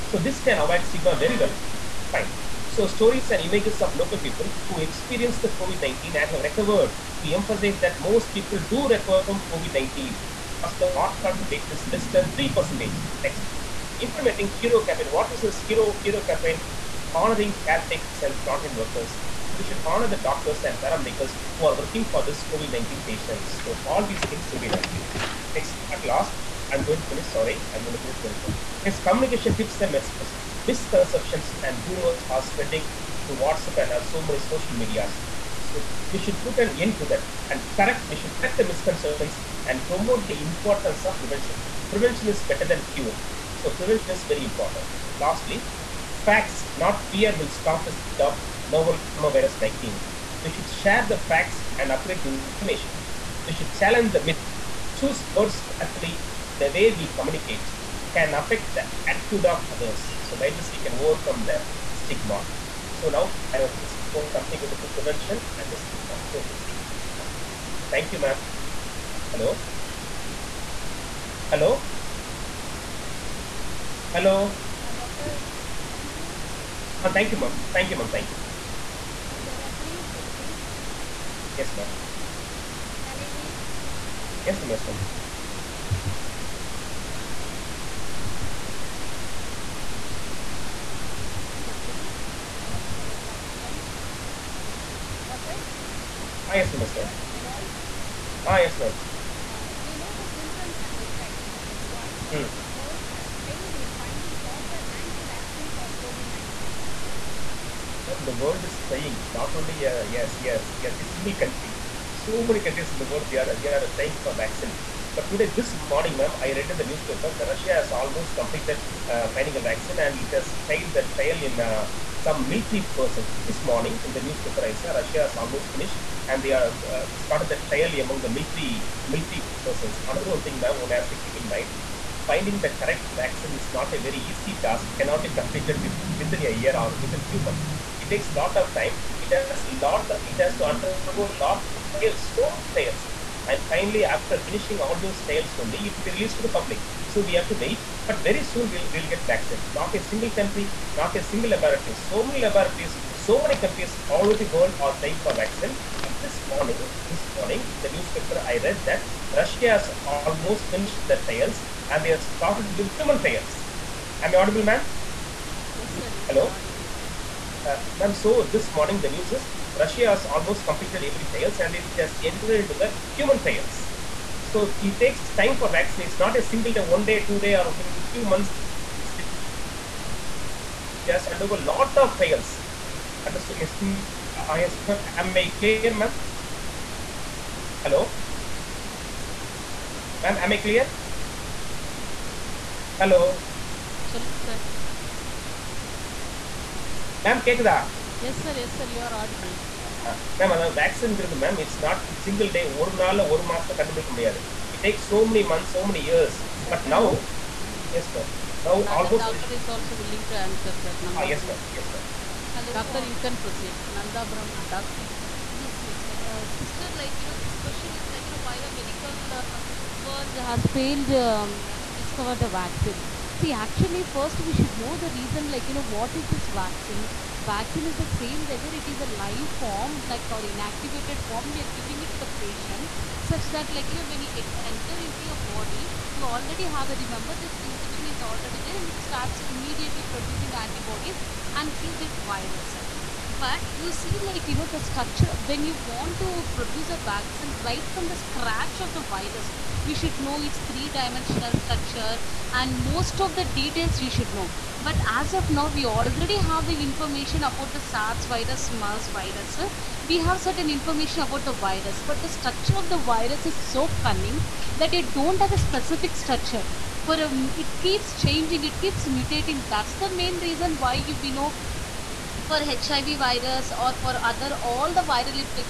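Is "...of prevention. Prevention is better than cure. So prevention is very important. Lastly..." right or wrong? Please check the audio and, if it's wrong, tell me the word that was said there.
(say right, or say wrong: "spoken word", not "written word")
right.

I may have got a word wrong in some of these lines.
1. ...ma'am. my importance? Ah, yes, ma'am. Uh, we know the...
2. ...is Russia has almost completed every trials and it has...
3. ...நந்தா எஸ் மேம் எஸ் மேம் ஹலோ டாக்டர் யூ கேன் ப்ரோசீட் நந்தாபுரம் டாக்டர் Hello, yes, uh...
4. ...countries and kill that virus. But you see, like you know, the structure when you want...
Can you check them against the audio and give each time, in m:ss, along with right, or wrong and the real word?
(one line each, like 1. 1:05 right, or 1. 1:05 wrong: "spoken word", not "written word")
1. 1:36 wrong: "voice", not "importance"
2. 2:49 right
3. 3:31 wrong: "Yes", not "Hello"
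4. 4:00 wrong: "antibodies", not "countries".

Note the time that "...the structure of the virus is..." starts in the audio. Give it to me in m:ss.
4:22.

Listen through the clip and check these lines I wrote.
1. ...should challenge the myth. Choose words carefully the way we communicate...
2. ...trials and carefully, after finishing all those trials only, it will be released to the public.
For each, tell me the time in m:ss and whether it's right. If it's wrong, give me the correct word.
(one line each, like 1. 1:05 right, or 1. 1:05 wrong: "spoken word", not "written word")
1. 0:53 right
2. 2:22 wrong: "finally", not "carefully".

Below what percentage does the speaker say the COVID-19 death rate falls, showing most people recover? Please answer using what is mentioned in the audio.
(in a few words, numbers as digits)
3%.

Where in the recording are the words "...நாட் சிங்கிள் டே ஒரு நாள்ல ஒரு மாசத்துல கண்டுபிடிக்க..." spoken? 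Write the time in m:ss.
3:21.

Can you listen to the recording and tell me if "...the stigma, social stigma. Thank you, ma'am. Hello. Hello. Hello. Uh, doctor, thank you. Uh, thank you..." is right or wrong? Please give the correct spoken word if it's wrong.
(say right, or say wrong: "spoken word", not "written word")
right.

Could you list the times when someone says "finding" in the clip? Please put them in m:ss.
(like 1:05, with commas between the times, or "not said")
1:43, 1:59, 2:12.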